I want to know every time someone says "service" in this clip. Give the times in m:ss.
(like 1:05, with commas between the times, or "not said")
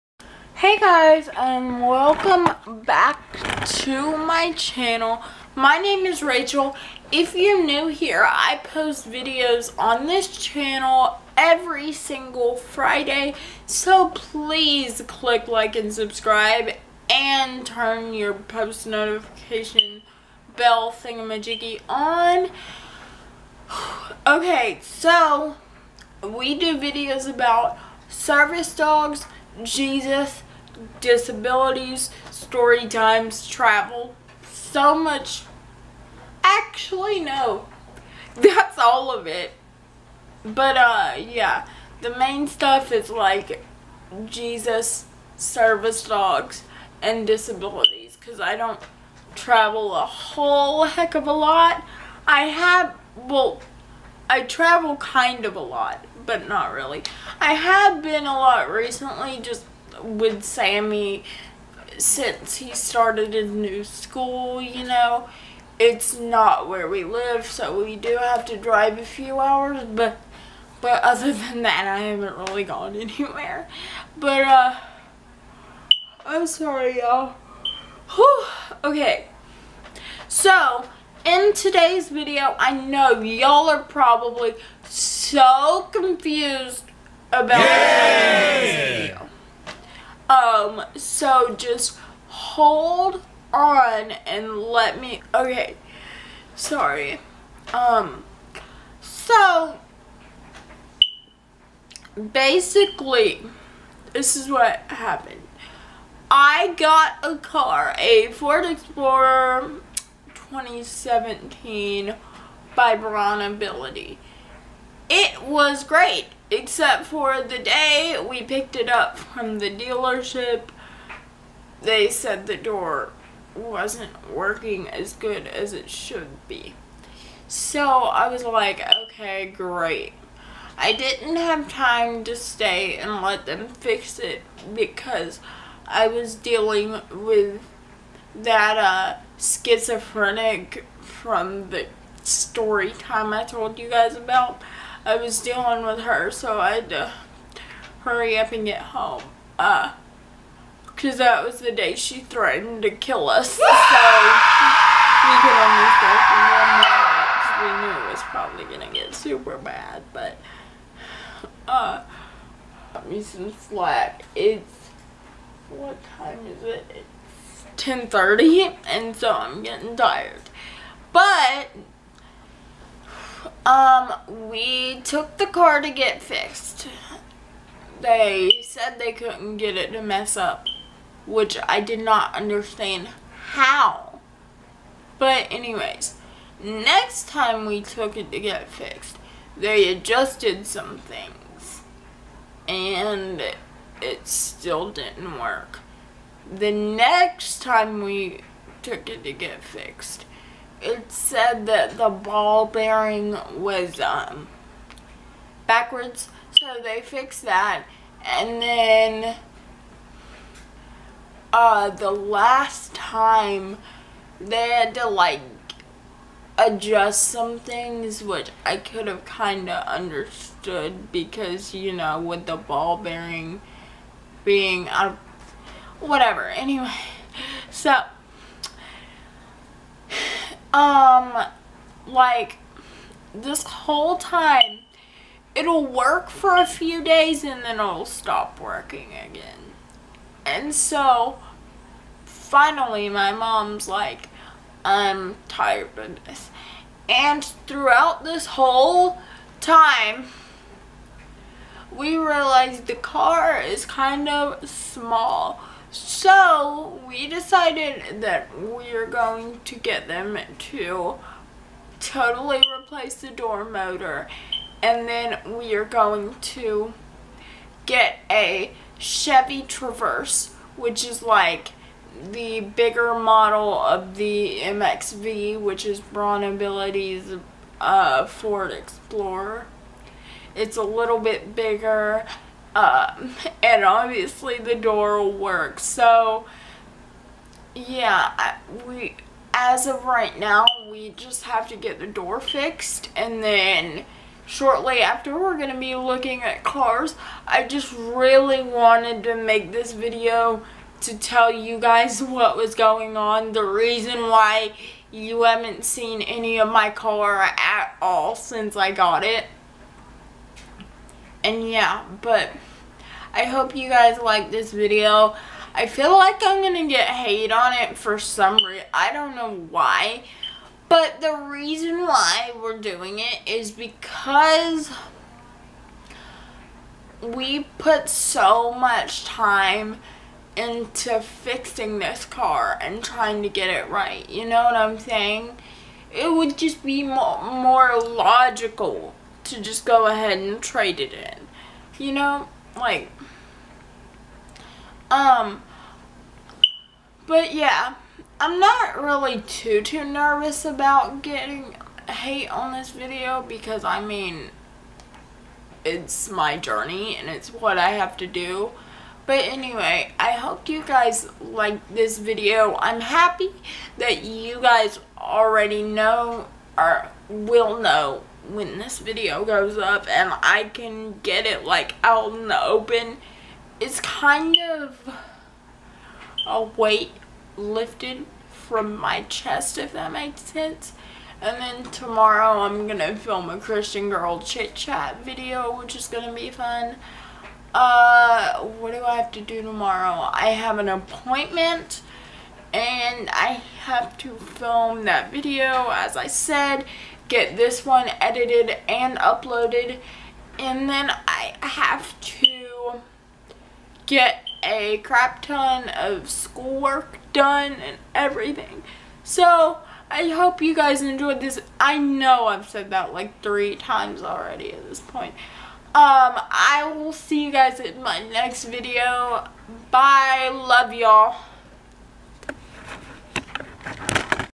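0:28, 0:45.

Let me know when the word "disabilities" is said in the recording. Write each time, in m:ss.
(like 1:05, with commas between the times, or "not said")
0:30, 0:47.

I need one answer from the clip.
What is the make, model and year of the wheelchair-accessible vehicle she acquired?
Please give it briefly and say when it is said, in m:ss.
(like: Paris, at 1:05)
Ford Explorer 2017, at 1:48.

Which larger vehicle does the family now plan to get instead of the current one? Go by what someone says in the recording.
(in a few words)
Chevy Traverse.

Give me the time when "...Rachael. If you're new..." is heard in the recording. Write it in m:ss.
0:06.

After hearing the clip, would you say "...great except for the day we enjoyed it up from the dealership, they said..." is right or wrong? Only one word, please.
wrong.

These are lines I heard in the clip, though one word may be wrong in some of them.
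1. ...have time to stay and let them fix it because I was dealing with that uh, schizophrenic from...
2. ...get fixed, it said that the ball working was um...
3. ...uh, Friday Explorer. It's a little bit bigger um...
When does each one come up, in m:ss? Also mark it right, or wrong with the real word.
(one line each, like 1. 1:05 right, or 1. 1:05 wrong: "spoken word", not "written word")
1. 2:11 right
2. 3:19 wrong: "bearing", not "working"
3. 4:37 wrong: "Ford", not "Friday".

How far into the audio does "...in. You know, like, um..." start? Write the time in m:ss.
5:41.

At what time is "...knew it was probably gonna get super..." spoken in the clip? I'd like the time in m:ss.
2:37.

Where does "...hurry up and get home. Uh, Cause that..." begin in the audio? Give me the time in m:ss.
2:28.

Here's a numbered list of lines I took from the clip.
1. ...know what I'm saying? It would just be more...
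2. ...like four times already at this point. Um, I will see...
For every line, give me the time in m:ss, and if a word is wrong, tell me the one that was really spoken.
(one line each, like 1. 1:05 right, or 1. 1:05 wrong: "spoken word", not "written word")
1. 5:34 right
2. 6:53 wrong: "three", not "four".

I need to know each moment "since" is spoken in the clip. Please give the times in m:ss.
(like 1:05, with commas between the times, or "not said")
1:01, 5:08.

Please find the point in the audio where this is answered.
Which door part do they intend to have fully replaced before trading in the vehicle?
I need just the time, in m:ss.
4:23.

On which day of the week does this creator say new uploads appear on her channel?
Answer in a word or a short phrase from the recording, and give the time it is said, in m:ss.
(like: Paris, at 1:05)
Friday, at 0:12.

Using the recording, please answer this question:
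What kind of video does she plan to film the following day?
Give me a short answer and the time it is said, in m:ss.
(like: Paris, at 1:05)
Christian Girl Chit Chat, at 6:23.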